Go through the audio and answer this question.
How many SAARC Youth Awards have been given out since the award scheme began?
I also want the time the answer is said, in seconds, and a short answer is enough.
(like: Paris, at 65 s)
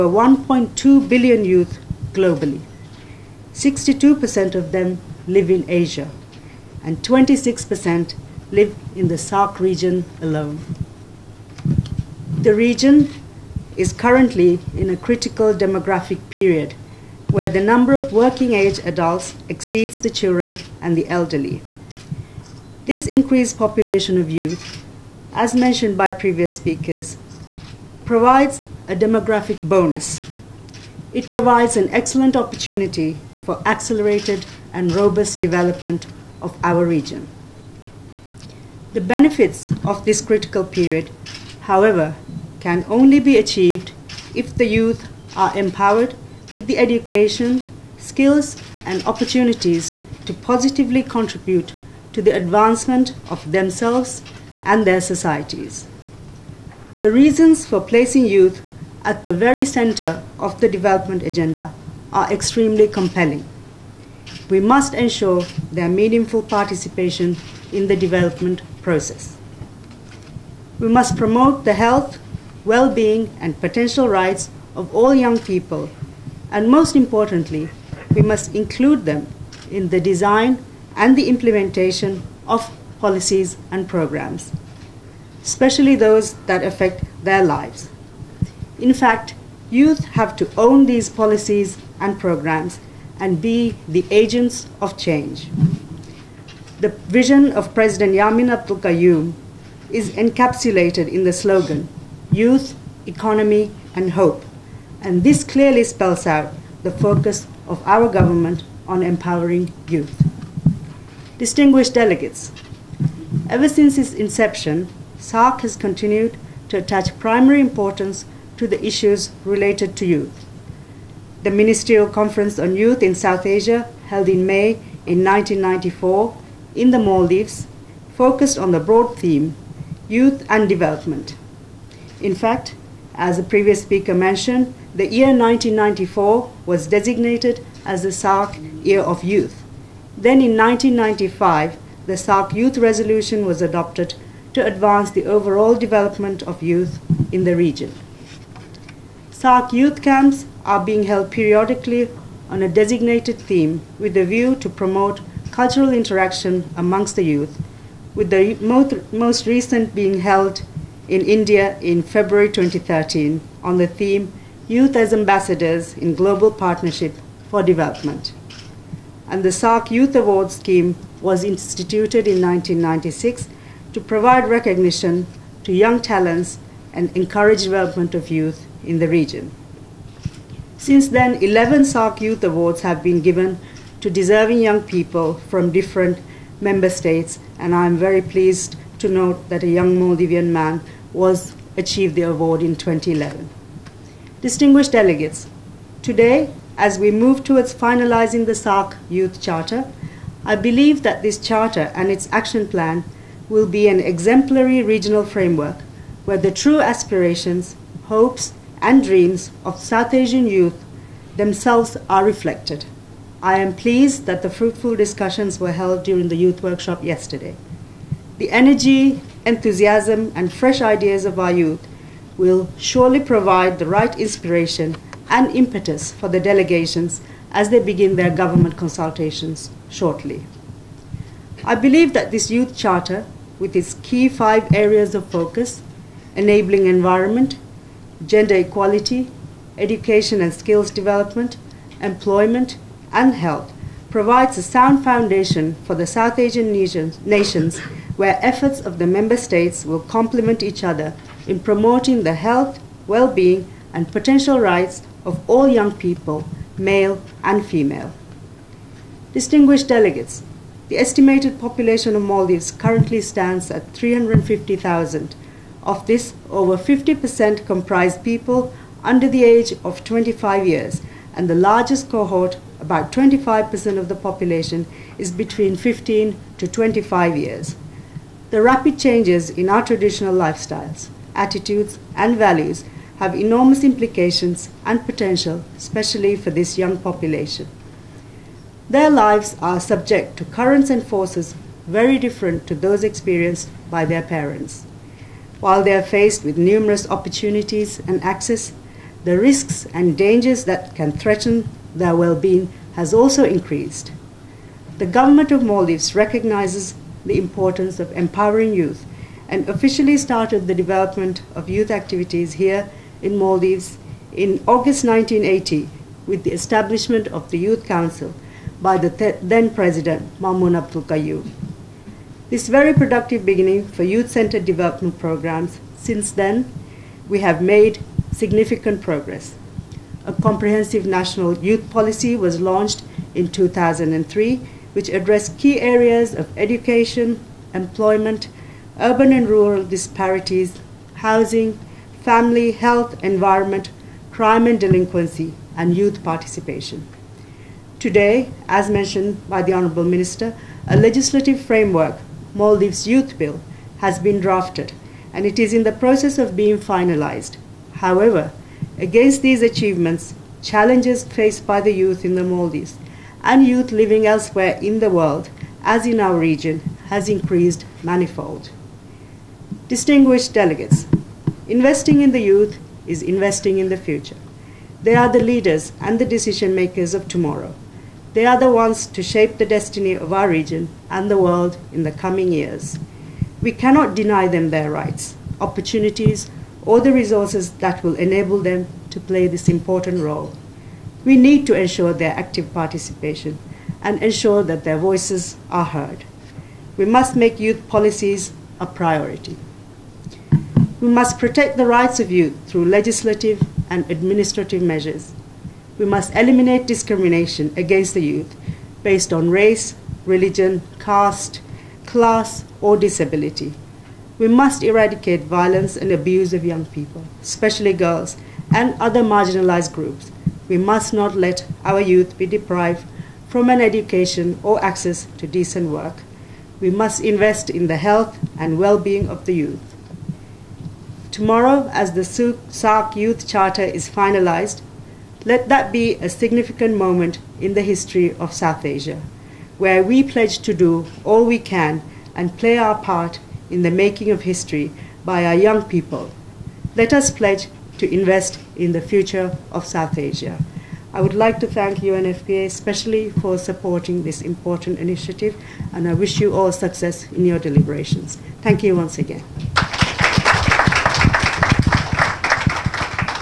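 11, at 181 s.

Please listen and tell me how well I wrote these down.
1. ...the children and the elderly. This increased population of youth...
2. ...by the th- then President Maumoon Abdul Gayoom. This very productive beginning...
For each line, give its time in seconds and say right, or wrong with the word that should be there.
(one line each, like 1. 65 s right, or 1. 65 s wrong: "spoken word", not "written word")
1. 19 s right
2. 318 s right.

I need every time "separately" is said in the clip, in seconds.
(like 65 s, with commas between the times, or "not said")
not said.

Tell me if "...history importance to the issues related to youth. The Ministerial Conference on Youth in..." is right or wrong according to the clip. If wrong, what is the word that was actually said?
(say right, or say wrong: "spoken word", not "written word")
wrong: "primary", not "history".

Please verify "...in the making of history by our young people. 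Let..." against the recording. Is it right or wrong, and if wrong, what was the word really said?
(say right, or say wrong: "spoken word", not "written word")
right.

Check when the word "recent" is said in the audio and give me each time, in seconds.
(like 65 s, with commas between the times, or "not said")
159 s.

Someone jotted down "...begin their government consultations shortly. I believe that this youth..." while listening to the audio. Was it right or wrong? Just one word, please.
right.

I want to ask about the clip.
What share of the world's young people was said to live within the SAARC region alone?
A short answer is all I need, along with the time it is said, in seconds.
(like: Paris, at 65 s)
26%, at 7 s.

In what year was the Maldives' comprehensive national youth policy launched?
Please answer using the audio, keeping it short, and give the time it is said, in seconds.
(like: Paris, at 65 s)
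2003, at 333 s.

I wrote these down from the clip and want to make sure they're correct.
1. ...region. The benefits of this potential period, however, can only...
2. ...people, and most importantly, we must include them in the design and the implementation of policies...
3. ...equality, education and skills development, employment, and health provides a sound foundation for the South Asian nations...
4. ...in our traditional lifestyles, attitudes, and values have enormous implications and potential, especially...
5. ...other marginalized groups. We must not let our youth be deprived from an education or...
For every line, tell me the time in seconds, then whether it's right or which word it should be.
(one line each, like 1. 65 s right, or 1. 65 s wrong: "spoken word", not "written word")
1. 36 s wrong: "critical", not "potential"
2. 75 s right
3. 238 s right
4. 279 s right
5. 418 s right.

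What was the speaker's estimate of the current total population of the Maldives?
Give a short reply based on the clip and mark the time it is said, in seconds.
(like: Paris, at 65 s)
350,000, at 263 s.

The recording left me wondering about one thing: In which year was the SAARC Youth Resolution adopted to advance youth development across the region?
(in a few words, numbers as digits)
1995.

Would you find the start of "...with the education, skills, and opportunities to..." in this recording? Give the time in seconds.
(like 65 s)
46 s.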